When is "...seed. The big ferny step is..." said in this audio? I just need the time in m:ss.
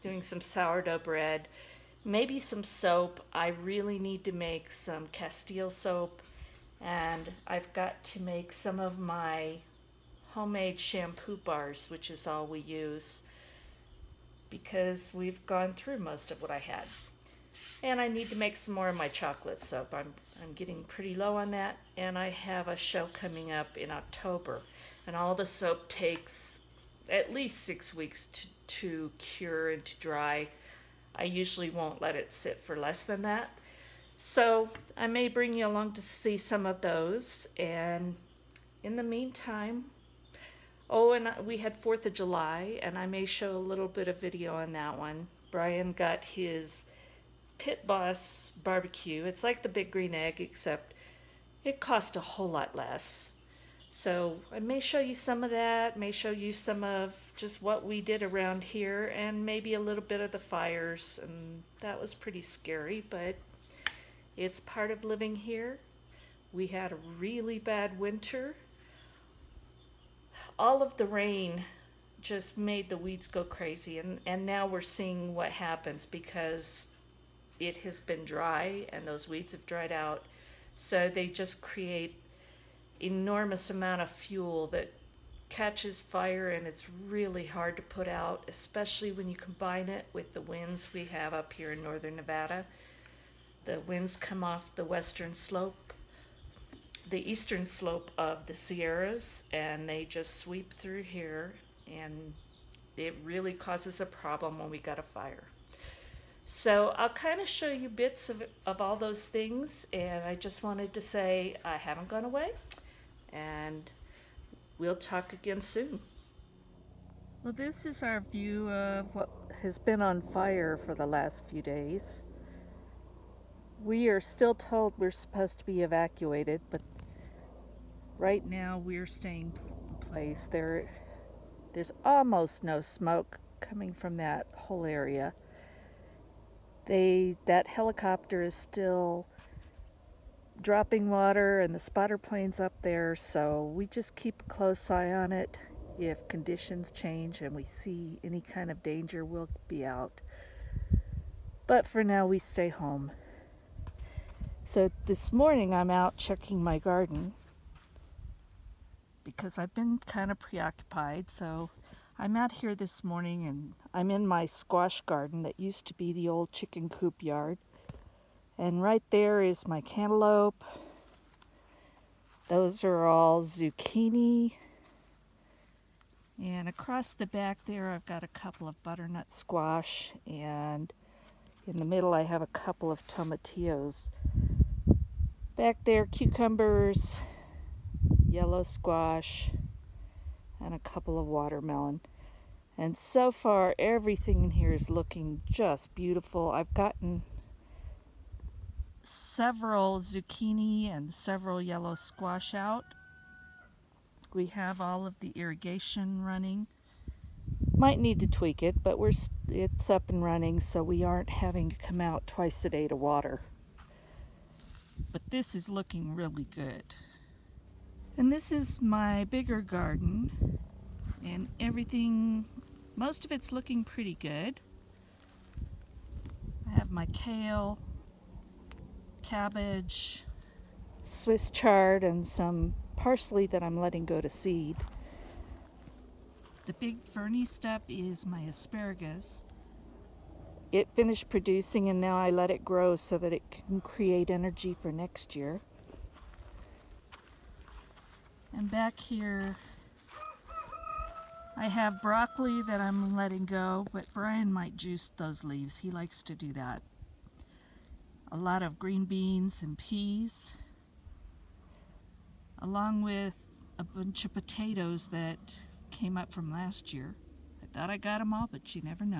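3:54.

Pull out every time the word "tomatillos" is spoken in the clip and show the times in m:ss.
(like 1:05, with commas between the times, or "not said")
3:03.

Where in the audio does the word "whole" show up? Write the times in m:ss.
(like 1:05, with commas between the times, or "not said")
0:52, 2:14.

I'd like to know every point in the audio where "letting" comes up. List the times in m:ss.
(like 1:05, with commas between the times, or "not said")
3:53, 4:13.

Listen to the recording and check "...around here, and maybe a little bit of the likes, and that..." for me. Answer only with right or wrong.
wrong.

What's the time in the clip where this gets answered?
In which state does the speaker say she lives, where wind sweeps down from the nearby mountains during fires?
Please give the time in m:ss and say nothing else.
1:32.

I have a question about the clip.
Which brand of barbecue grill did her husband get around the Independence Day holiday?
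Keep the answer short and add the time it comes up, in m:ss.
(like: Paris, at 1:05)
Pit Boss, at 0:47.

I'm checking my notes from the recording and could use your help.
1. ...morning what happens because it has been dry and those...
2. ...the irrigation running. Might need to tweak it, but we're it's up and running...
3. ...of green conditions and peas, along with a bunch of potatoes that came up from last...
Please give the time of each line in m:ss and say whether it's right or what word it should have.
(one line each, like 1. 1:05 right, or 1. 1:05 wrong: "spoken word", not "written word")
1. 1:14 wrong: "seeing", not "morning"
2. 3:25 right
3. 4:18 wrong: "beans", not "conditions".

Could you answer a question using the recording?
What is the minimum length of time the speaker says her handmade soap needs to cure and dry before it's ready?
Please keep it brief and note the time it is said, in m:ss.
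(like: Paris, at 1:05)
6 weeks, at 0:27.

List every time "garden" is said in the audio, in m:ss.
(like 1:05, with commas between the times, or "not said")
2:36, 2:45, 3:39.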